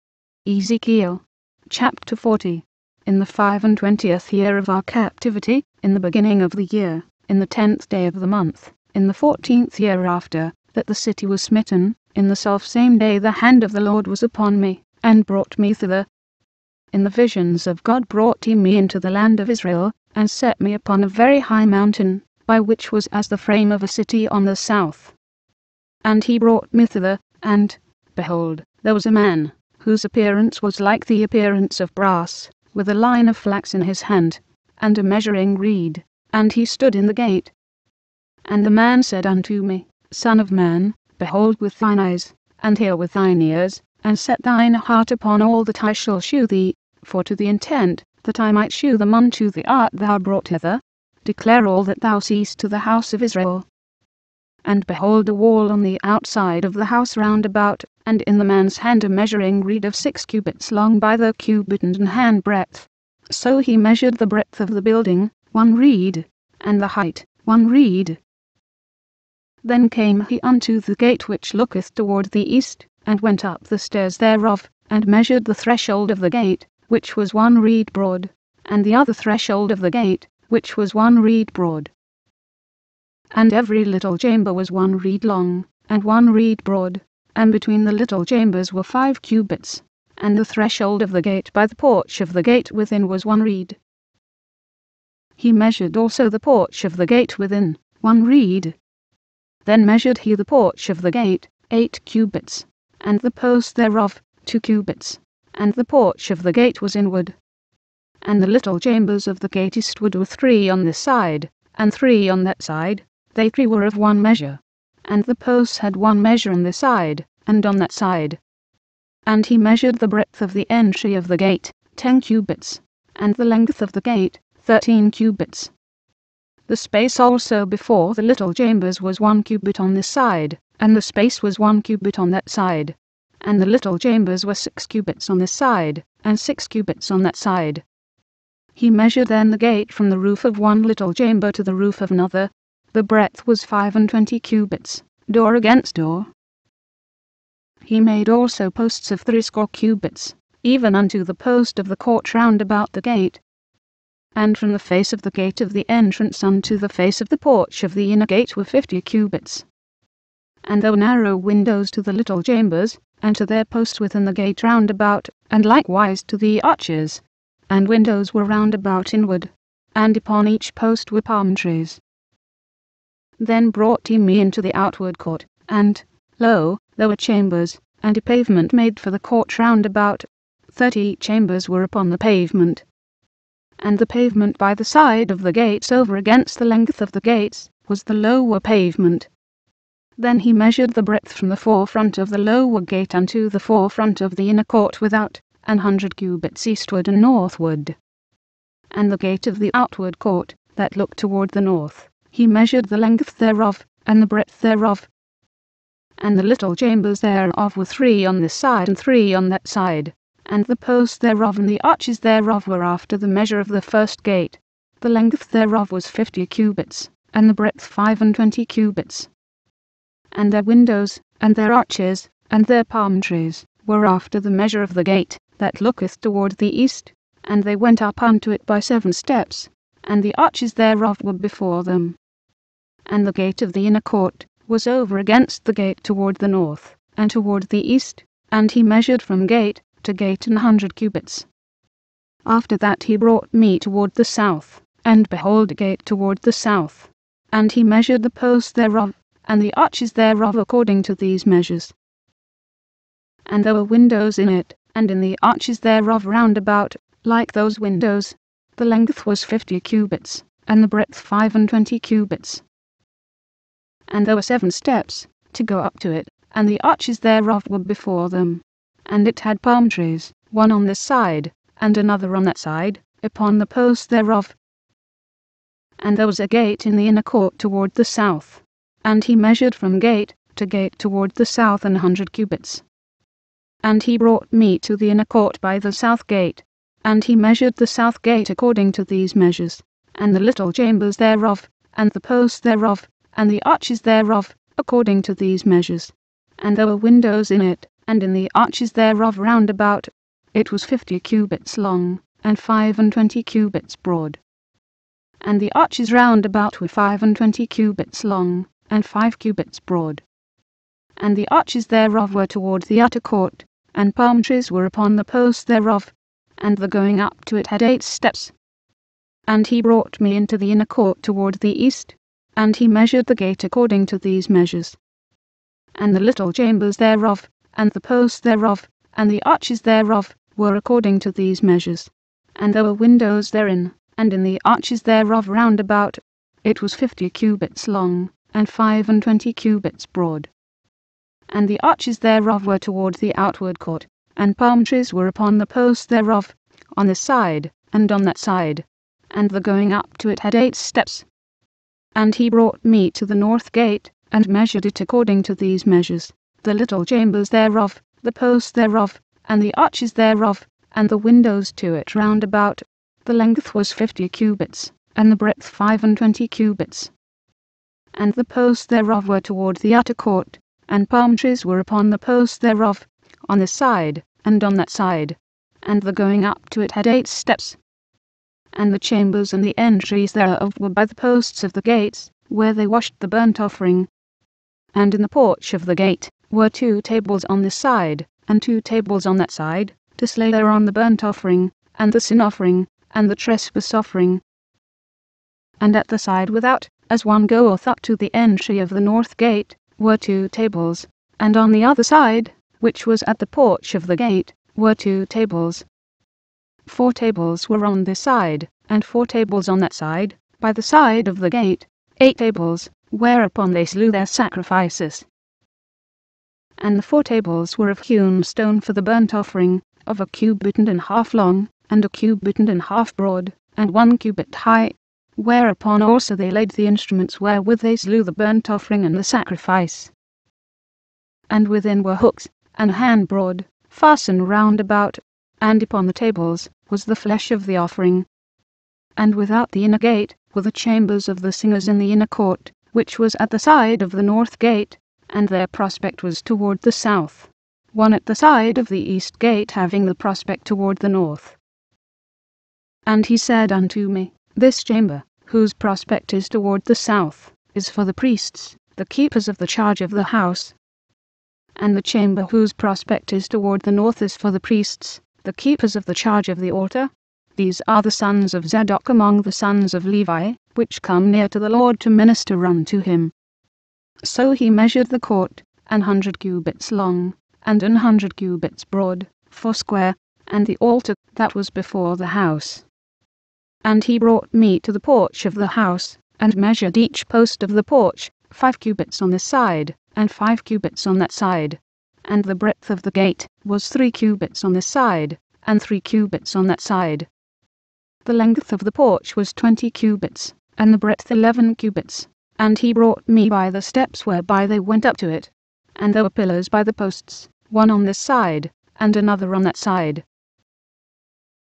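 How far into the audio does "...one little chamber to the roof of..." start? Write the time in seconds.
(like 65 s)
140 s.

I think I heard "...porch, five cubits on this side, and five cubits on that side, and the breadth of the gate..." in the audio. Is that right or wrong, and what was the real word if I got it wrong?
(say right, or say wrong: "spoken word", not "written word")
right.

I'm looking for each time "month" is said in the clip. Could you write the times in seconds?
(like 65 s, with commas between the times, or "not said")
8 s.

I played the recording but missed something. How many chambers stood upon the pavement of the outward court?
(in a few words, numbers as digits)
30.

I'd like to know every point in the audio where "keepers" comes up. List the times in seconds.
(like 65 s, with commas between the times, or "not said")
459 s, 465 s.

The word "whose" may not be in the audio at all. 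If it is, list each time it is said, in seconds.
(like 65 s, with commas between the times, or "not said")
29 s, 455 s, 462 s.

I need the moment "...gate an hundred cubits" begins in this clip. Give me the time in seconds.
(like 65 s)
240 s.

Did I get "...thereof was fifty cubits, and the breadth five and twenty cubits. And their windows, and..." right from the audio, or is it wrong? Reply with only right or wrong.
right.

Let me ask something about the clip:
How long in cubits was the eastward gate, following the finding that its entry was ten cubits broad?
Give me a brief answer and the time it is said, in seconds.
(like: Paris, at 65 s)
13 cubits, at 124 s.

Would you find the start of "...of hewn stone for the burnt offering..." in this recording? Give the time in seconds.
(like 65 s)
417 s.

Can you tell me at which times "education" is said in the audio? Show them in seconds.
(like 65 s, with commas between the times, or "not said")
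not said.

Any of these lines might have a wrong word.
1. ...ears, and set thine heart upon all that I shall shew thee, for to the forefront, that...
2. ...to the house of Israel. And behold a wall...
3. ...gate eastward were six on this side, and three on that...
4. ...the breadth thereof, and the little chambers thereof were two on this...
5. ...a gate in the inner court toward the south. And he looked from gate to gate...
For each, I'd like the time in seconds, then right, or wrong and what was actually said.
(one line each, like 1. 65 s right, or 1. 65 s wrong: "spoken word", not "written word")
1. 43 s wrong: "intent", not "forefront"
2. 52 s right
3. 109 s wrong: "three", not "six"
4. 204 s wrong: "three", not "two"
5. 276 s wrong: "measured", not "looked".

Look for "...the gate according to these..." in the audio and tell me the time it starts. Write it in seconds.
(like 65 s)
323 s.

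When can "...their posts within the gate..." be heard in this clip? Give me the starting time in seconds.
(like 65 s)
163 s.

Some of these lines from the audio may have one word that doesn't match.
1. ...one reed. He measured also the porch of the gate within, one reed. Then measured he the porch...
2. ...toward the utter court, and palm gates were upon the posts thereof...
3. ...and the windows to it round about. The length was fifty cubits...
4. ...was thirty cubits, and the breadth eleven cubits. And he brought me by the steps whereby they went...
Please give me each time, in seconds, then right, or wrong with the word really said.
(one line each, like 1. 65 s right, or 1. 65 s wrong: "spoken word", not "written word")
1. 93 s right
2. 312 s wrong: "trees", not "gates"
3. 360 s right
4. 499 s wrong: "twenty", not "thirty".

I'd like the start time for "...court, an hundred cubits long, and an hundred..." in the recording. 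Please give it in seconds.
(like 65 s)
475 s.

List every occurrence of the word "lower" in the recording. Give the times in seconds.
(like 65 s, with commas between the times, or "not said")
188 s, 192 s.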